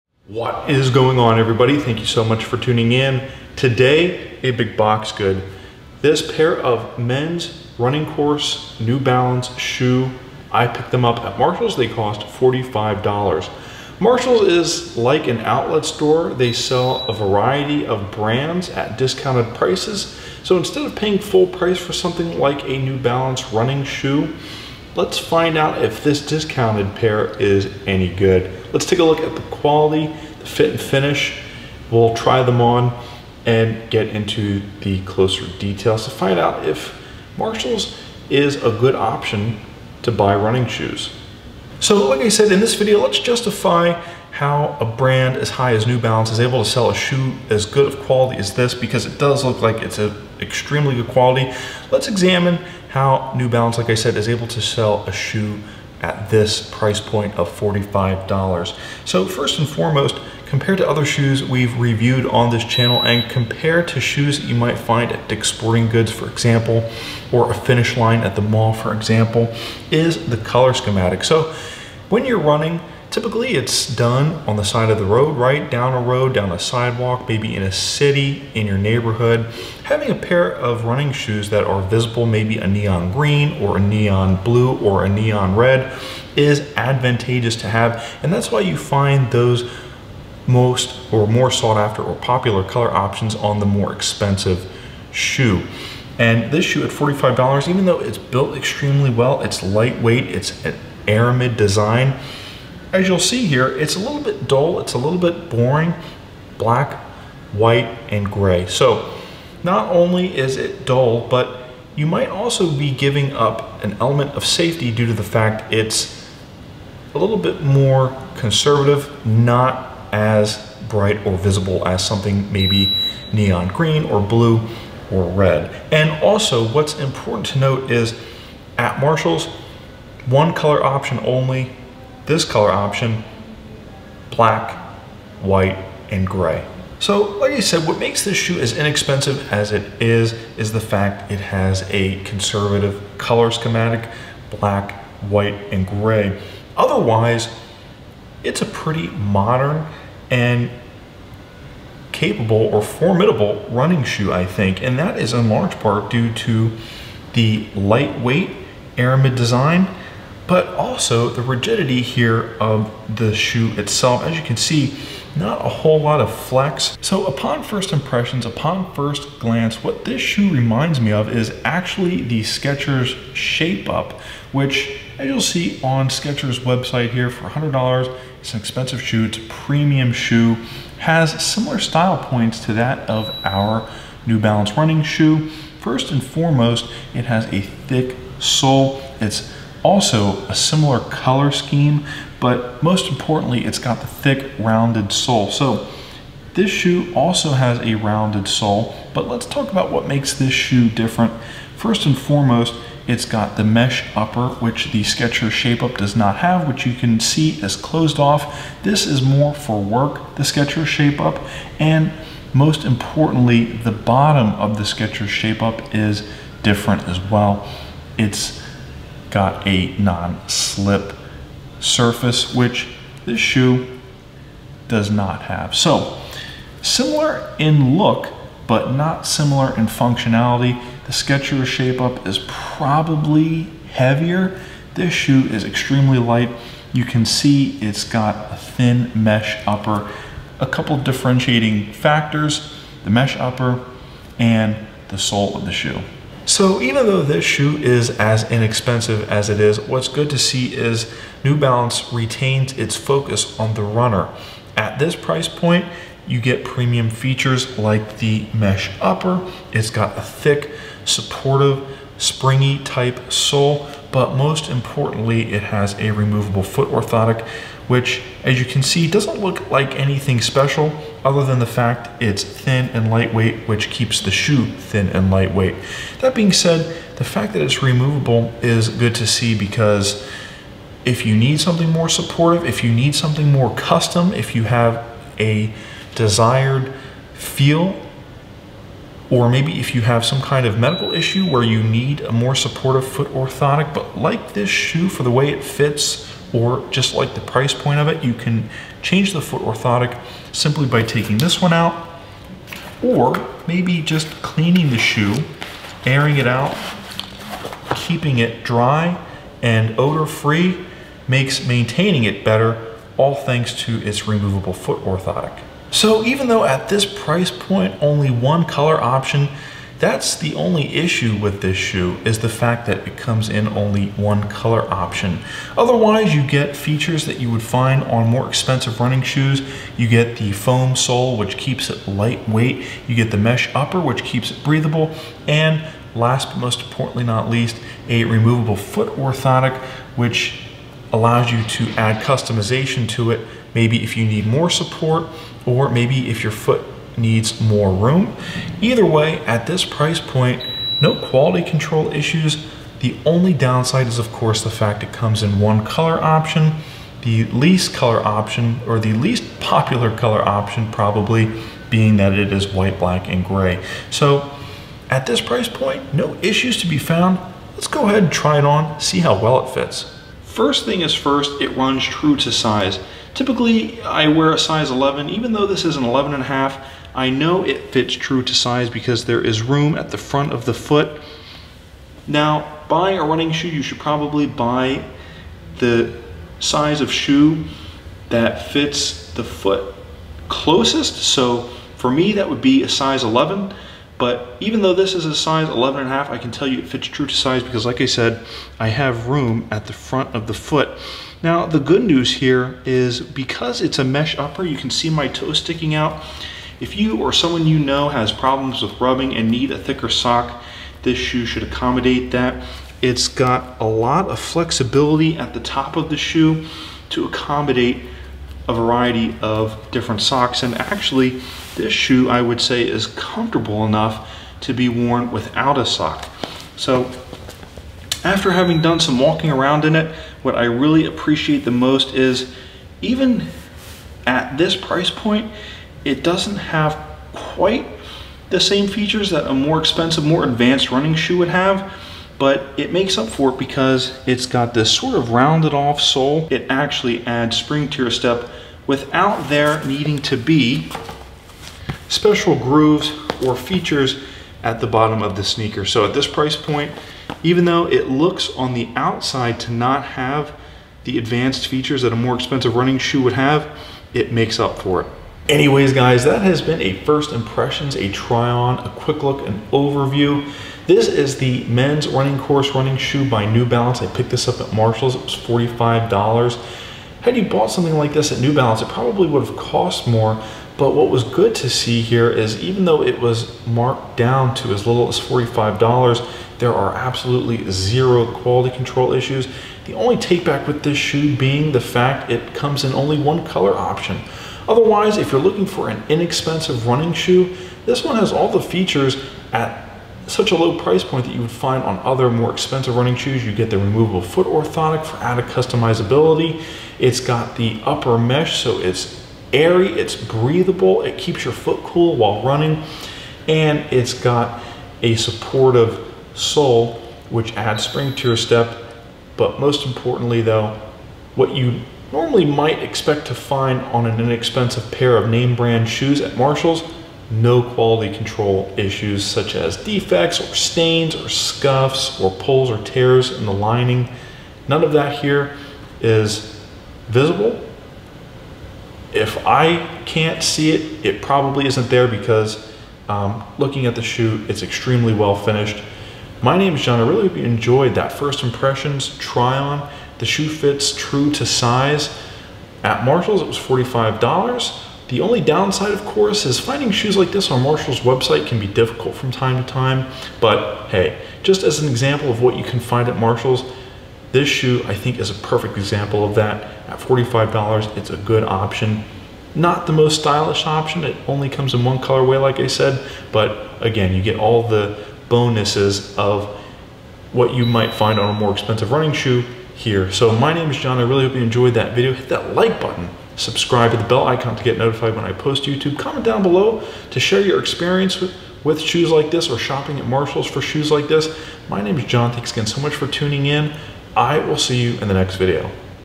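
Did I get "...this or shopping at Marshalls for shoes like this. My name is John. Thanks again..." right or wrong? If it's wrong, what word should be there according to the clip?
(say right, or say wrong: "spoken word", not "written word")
right.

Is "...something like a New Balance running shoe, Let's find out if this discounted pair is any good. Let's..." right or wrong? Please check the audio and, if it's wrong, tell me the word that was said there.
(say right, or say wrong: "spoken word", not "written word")
right.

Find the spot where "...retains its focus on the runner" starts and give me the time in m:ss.
4:12.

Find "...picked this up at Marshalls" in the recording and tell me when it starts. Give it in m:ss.
7:54.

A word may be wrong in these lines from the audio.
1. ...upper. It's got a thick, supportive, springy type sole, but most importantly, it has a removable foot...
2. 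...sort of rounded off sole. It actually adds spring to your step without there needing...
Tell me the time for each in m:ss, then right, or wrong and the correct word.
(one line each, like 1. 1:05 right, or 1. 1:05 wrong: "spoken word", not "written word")
1. 4:19 right
2. 7:24 right.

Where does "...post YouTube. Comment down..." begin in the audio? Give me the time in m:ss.
9:45.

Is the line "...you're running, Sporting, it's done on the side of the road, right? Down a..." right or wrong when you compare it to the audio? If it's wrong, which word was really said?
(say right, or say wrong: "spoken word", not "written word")
wrong: "Typically", not "Sporting".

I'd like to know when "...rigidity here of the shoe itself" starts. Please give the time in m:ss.
2:41.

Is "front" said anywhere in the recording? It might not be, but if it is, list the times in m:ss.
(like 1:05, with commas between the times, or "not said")
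6:20, 6:39.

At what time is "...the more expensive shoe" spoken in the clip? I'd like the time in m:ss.
1:33.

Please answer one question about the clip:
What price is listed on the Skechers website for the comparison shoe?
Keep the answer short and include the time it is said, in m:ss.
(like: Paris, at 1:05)
$100, at 2:57.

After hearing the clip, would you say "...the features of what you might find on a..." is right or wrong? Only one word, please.
wrong.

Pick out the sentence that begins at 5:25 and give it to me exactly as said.
Otherwise, you get features that you would find on more expensive running shoes.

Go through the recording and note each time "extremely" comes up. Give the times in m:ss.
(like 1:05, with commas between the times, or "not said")
0:50, 1:38, 3:55, 9:04.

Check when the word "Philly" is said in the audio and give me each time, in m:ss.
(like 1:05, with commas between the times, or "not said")
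not said.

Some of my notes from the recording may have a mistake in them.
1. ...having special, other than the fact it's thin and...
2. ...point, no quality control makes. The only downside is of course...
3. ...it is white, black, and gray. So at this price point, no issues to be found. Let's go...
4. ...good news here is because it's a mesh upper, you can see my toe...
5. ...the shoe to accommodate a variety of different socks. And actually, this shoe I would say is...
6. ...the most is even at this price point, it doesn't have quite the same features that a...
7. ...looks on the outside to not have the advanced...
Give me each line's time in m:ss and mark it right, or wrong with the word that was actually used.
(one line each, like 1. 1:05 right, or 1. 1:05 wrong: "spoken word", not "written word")
1. 4:29 wrong: "anything", not "having"
2. 5:50 wrong: "issues", not "makes"
3. 6:02 right
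4. 6:41 right
5. 6:56 right
6. 7:11 right
7. 7:38 right.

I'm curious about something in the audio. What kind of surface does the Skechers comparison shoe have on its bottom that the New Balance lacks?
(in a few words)
non-slip surface.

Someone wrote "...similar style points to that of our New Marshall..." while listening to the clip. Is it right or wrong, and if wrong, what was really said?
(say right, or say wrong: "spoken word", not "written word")
wrong: "Balance", not "Marshall".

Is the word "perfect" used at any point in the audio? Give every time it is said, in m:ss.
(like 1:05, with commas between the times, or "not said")
9:25.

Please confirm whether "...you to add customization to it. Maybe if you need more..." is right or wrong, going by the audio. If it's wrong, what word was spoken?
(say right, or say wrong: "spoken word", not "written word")
right.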